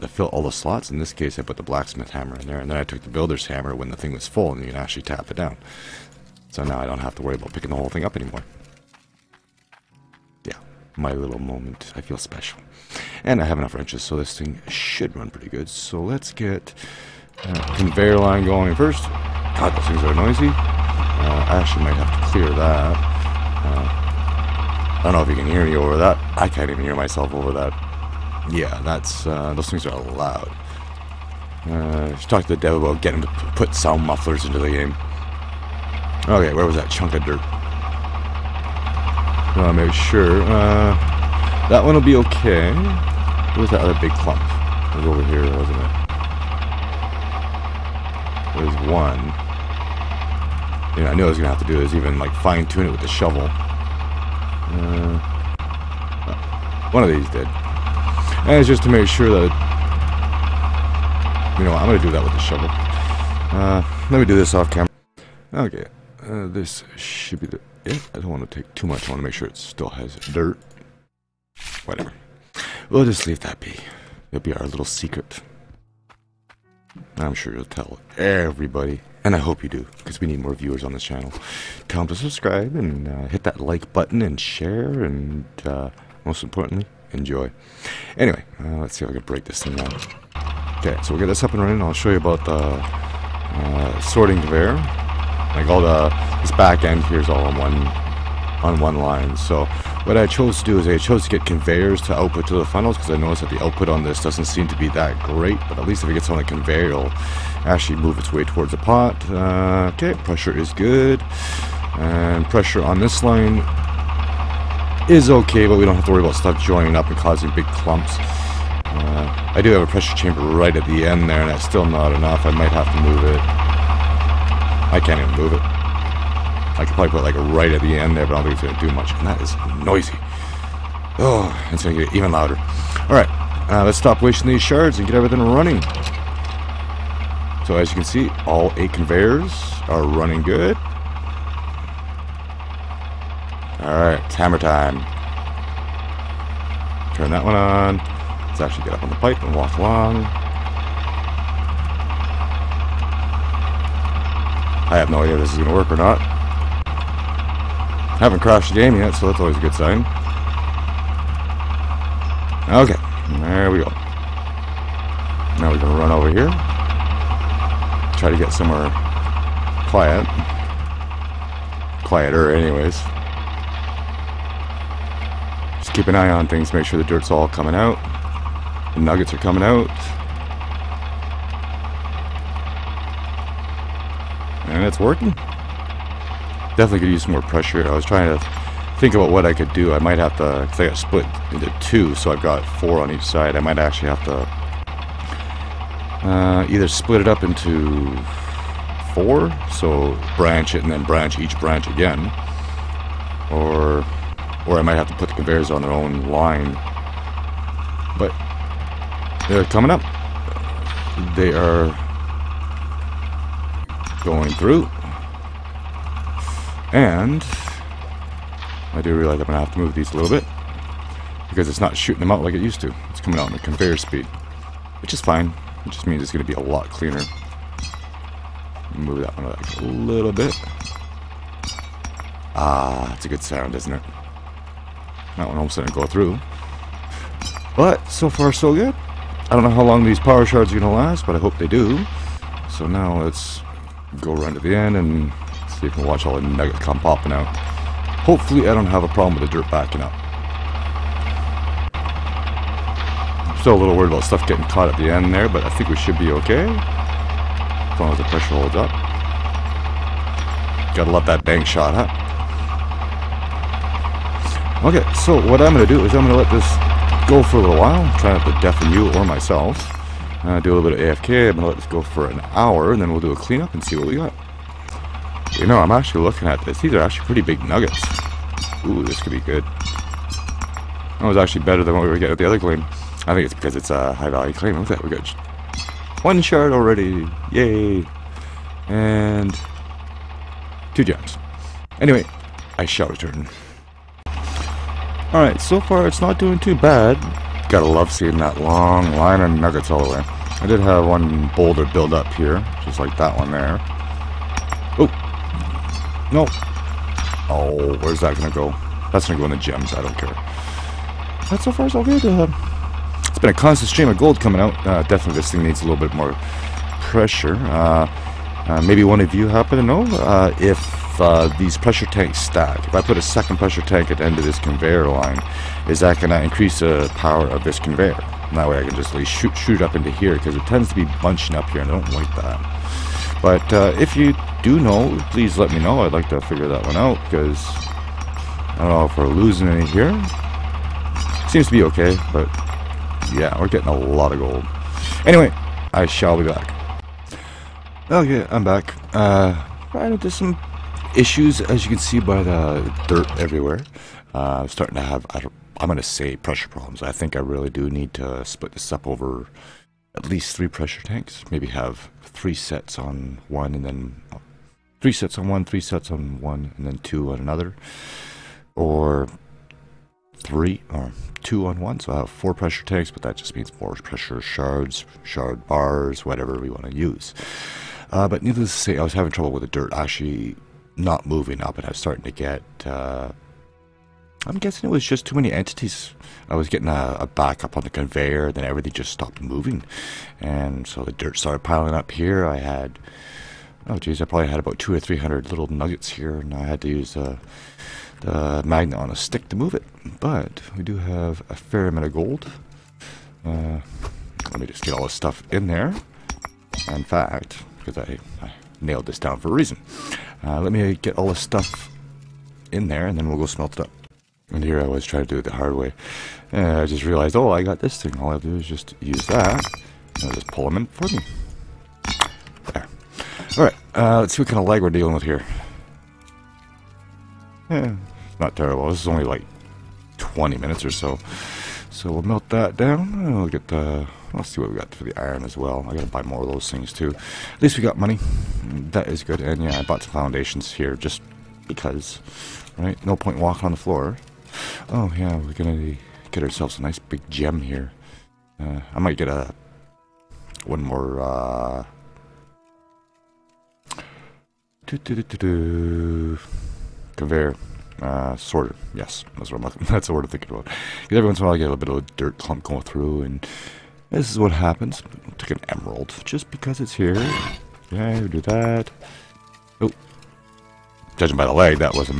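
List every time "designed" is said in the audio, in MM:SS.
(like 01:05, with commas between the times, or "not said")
not said.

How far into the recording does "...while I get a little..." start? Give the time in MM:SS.
07:41.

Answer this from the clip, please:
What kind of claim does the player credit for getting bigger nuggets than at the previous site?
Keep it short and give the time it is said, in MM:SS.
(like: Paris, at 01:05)
high value claim, at 04:44.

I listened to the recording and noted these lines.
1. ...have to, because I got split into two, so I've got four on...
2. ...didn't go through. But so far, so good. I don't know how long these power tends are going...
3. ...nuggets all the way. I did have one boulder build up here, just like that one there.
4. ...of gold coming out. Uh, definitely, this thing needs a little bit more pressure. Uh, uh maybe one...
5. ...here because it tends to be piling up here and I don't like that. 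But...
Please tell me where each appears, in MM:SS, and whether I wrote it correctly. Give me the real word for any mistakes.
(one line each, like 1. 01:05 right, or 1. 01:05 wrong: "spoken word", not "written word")
1. 03:10 right
2. 03:55 wrong: "shards", not "tends"
3. 04:59 right
4. 05:14 right
5. 05:30 wrong: "bunching", not "piling".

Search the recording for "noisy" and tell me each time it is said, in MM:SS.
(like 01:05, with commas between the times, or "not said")
00:20, 02:09.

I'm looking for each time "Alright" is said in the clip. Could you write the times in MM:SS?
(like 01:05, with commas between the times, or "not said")
04:54, 07:03.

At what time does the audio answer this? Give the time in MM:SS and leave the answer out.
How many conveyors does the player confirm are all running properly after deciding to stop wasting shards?
02:18.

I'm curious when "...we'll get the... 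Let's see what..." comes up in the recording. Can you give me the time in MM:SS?
07:13.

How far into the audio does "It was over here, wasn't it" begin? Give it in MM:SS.
00:44.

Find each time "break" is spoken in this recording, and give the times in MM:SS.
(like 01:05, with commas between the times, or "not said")
01:29.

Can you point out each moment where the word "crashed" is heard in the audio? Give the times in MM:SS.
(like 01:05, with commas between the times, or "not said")
02:38.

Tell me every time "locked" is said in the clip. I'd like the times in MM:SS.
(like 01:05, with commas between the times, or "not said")
not said.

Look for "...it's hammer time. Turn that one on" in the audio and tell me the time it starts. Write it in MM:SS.
02:24.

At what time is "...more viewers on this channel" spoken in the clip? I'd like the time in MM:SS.
01:20.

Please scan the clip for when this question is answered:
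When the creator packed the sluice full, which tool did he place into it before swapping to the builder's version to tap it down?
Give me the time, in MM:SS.
00:01.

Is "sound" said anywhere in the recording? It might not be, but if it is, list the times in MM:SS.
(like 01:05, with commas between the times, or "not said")
00:33, 03:53.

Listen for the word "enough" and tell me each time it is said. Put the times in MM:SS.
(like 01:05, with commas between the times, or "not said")
00:13, 02:02.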